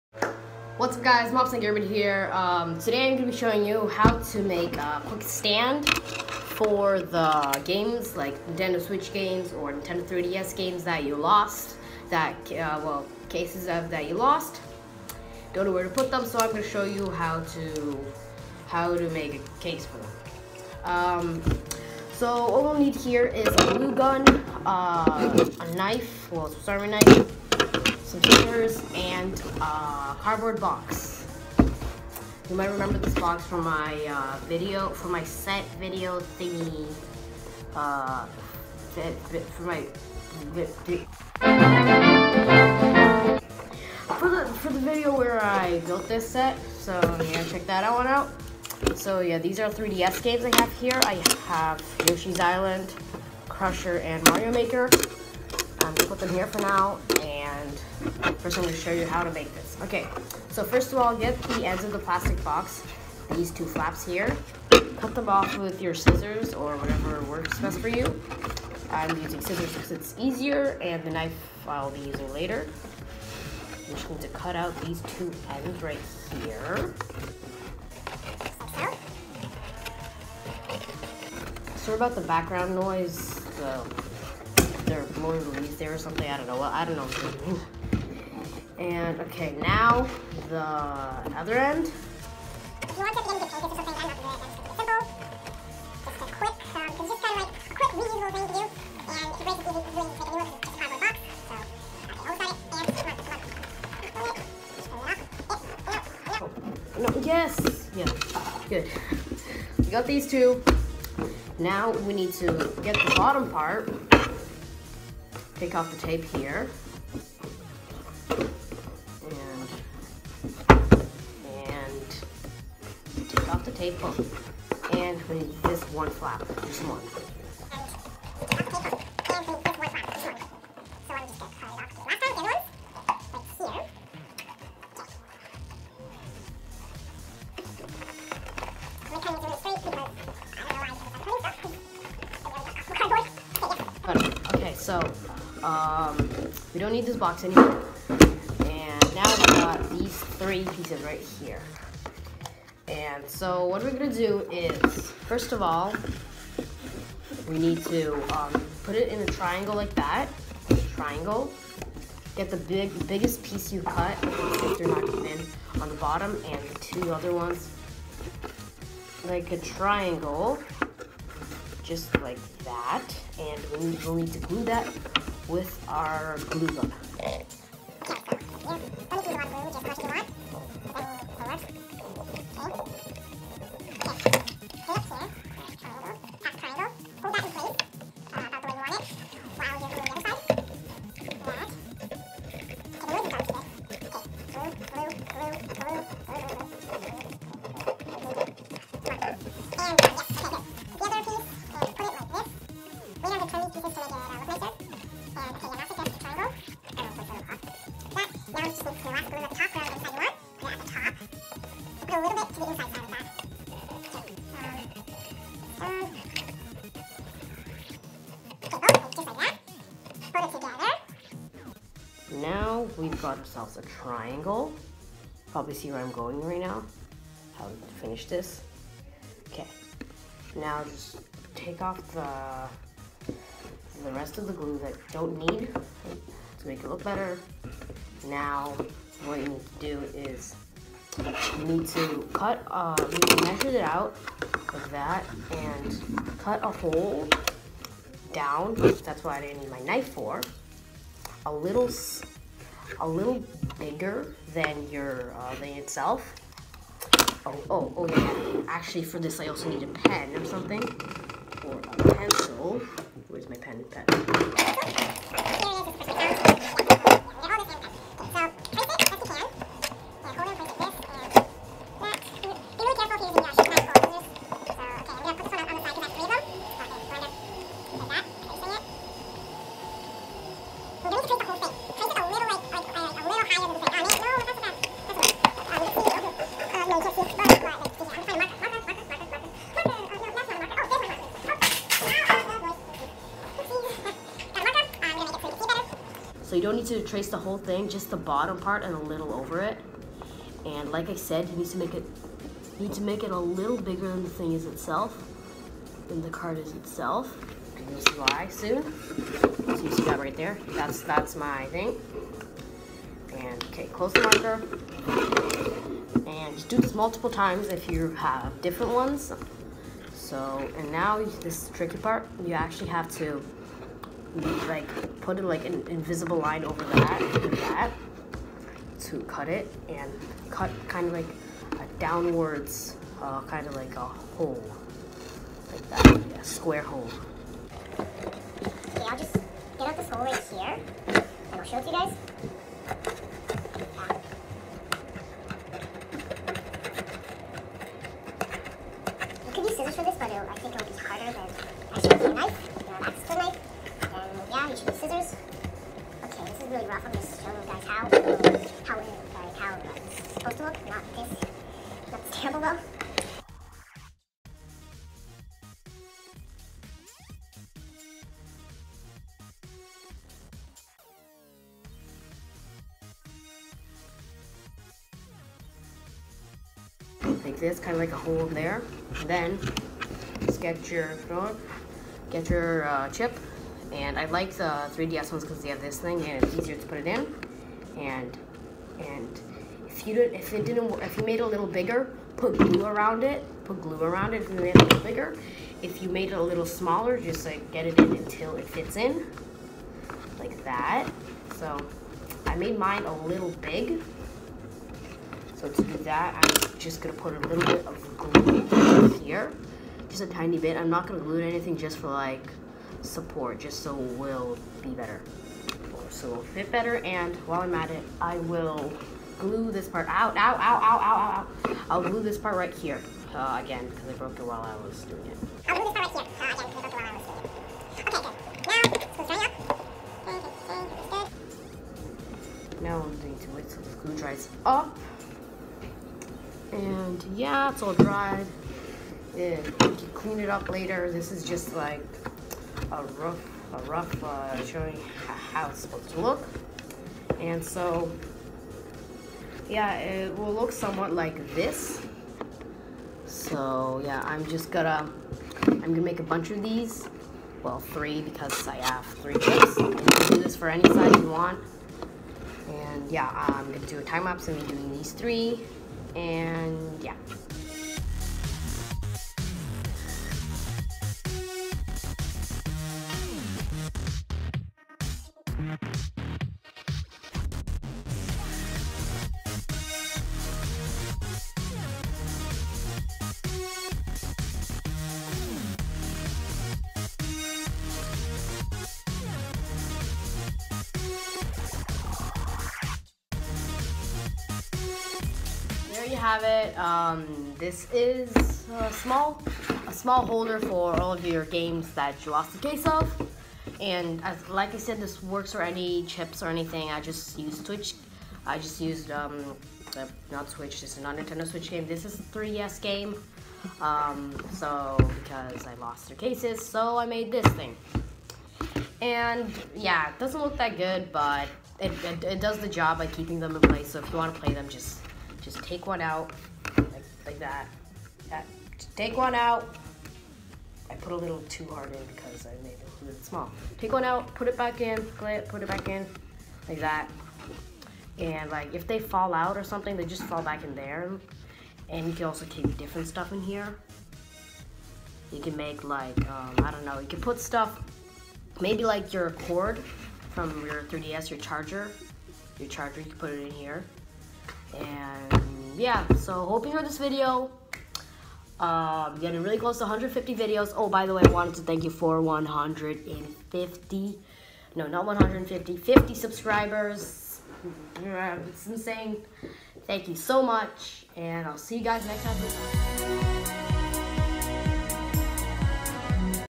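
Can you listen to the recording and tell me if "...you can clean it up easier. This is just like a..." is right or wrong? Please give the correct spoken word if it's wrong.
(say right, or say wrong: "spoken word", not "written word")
wrong: "later", not "easier".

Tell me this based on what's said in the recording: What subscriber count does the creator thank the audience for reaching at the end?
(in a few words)
50.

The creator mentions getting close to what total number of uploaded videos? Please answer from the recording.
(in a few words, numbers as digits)
150.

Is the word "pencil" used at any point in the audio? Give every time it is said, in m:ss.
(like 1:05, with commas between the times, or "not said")
4:22.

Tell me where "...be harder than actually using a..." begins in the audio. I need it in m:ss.
5:50.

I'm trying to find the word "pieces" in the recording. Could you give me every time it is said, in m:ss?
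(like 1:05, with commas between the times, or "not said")
2:30, 2:43.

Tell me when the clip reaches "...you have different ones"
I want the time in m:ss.
5:17.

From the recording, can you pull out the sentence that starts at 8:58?
And like if they fall out or something, they just fall back in there.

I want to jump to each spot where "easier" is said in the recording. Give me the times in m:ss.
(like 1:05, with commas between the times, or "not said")
1:10, 6:26.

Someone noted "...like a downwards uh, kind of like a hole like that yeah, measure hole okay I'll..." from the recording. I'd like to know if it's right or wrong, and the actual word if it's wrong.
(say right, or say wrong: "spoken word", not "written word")
wrong: "square", not "measure".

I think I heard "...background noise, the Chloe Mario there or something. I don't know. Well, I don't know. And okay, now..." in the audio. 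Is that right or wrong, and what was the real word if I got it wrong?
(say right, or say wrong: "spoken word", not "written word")
wrong: "Louise", not "Mario".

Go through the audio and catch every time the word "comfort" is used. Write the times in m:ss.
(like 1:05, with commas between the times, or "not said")
not said.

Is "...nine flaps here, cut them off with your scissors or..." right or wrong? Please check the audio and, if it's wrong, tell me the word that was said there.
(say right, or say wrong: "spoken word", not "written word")
wrong: "two", not "nine".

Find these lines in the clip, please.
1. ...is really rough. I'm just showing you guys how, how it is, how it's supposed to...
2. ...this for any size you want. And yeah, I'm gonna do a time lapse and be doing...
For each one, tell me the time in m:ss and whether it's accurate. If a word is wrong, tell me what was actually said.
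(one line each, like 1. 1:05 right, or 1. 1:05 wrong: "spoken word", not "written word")
1. 5:56 right
2. 7:40 right.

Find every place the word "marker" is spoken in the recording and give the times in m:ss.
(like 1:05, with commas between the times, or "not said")
5:14.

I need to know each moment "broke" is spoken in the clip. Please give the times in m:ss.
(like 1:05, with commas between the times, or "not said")
7:04, 7:09.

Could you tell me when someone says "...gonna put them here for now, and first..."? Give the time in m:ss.
0:55.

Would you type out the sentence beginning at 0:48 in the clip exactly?
So yeah, these are 3DS games I have here.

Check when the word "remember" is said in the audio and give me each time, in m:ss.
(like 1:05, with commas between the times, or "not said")
0:32.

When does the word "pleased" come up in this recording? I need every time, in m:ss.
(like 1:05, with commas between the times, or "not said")
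not said.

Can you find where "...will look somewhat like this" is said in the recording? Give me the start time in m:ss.
7:30.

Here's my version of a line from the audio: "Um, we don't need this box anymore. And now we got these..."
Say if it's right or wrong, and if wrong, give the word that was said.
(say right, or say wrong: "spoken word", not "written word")
right.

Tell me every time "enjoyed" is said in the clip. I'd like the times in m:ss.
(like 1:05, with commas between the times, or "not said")
9:16.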